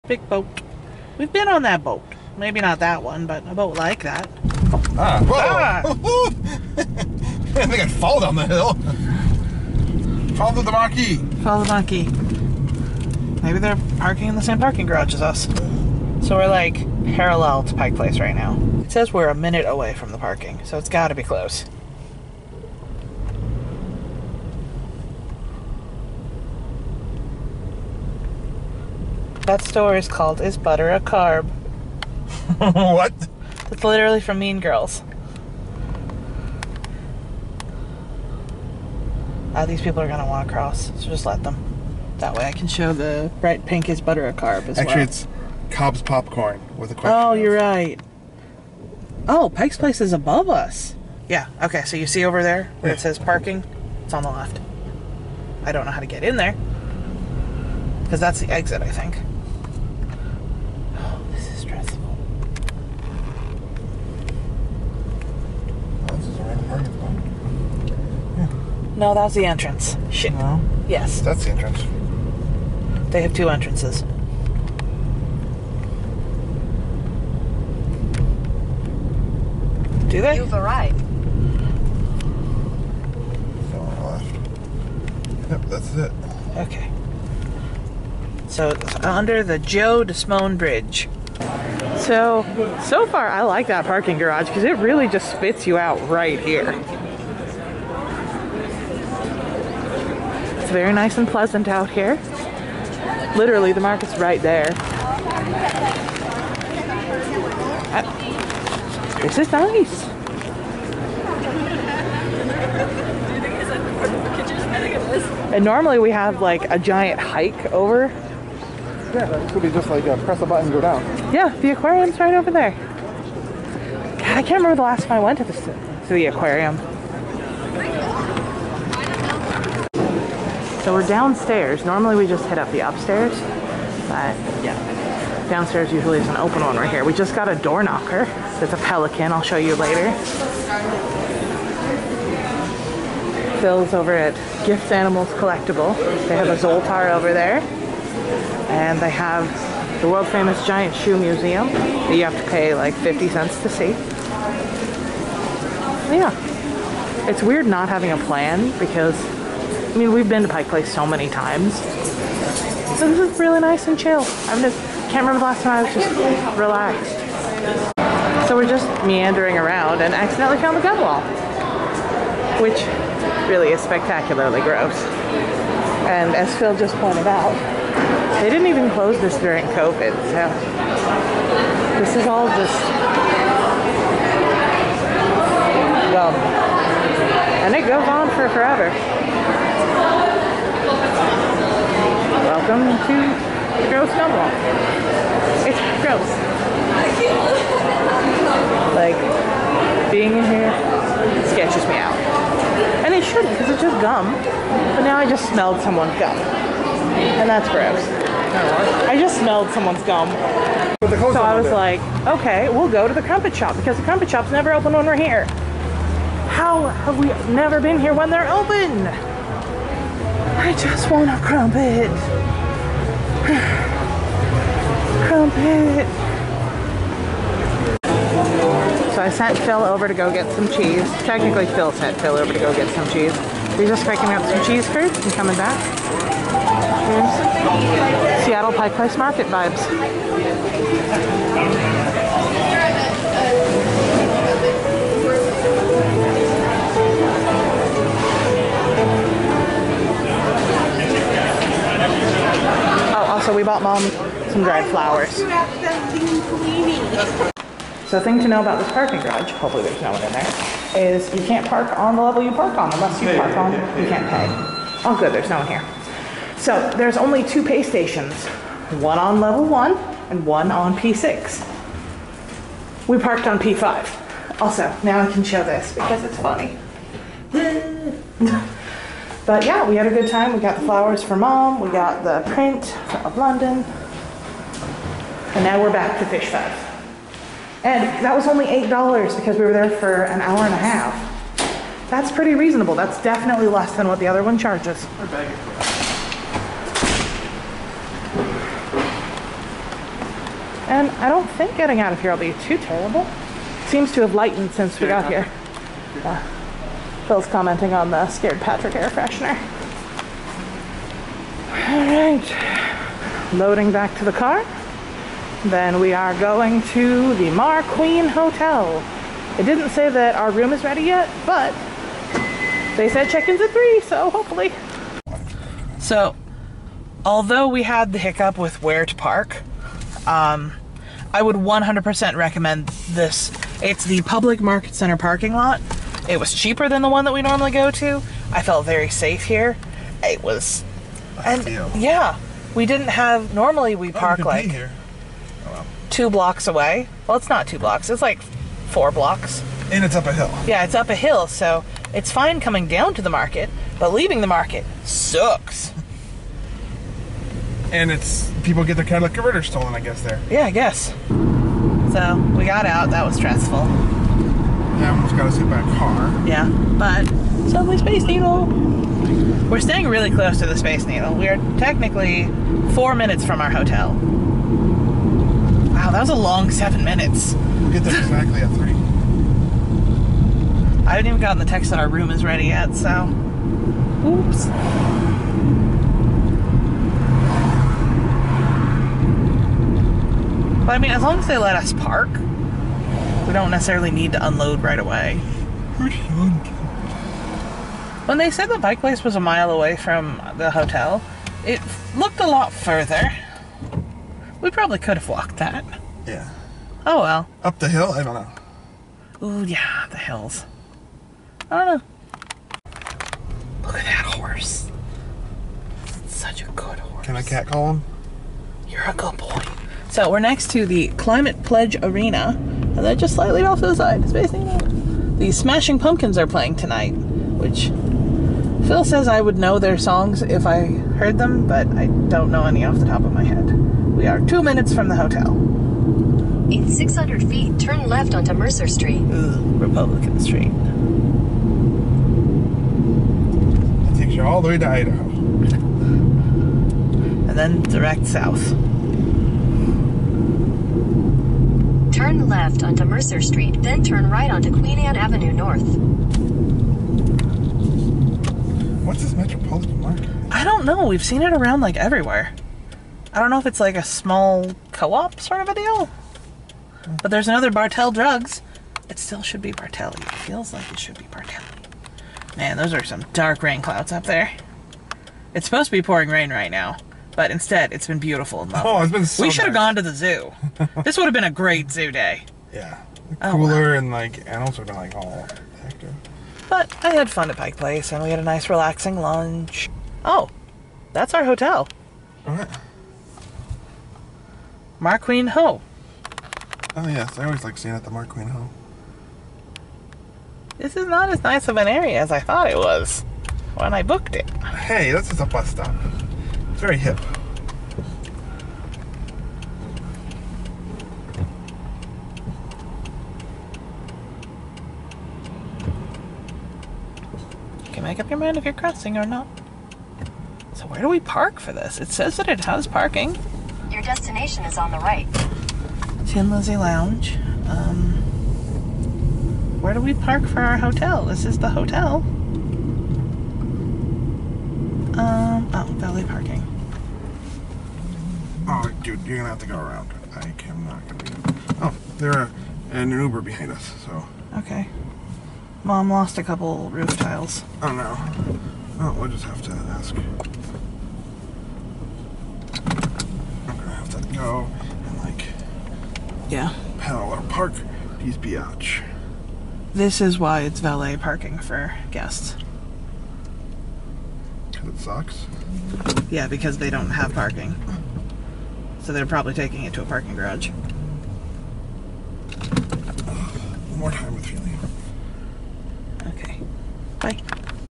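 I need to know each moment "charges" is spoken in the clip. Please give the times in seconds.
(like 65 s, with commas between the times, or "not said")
294 s.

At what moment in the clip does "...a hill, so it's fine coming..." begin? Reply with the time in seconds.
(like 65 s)
351 s.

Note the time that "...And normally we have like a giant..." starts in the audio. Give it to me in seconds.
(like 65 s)
115 s.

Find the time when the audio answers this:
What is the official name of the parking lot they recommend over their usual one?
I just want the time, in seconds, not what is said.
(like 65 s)
334 s.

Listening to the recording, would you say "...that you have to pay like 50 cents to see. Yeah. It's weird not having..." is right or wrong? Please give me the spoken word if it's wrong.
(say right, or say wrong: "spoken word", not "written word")
right.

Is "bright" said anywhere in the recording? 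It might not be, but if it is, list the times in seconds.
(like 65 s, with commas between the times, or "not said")
43 s.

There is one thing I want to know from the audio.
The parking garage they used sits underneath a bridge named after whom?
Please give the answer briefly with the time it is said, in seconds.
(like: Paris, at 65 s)
Joe Desimone, at 89 s.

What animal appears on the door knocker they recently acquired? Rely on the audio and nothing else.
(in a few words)
A pelican.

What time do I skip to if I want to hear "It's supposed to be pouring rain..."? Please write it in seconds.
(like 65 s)
475 s.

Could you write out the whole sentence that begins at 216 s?
How have we never been here when they're open?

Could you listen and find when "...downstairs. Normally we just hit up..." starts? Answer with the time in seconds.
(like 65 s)
131 s.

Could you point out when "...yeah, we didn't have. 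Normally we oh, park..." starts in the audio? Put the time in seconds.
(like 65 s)
341 s.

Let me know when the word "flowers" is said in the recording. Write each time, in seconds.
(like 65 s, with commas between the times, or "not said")
254 s, 280 s.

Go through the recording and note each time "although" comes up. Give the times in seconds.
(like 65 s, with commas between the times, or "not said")
327 s.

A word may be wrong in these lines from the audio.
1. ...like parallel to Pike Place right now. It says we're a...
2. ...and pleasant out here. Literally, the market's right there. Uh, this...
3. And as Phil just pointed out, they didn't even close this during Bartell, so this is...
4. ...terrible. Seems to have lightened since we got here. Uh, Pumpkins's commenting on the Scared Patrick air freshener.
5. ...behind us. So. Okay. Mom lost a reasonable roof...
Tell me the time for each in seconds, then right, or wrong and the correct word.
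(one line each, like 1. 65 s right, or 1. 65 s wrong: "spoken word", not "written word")
1. 16 s right
2. 101 s right
3. 176 s wrong: "COVID", not "Bartell"
4. 302 s wrong: "Phil", not "Pumpkins"
5. 543 s wrong: "couple", not "reasonable".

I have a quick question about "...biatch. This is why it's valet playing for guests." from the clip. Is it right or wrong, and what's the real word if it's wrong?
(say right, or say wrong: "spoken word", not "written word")
wrong: "parking", not "playing".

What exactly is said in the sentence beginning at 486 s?
But I had fun at Pike Place and we had a nice relaxing lunch.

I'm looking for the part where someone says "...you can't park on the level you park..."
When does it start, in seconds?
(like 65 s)
261 s.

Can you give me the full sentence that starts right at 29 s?
That store is called Is Butter a Carb?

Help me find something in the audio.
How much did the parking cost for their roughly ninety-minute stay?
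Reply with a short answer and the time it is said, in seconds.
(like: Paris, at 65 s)
$8, at 288 s.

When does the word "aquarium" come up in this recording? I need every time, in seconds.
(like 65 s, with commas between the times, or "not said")
121 s, 126 s.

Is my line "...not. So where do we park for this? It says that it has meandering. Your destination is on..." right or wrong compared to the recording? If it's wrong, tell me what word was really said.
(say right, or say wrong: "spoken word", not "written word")
wrong: "parking", not "meandering".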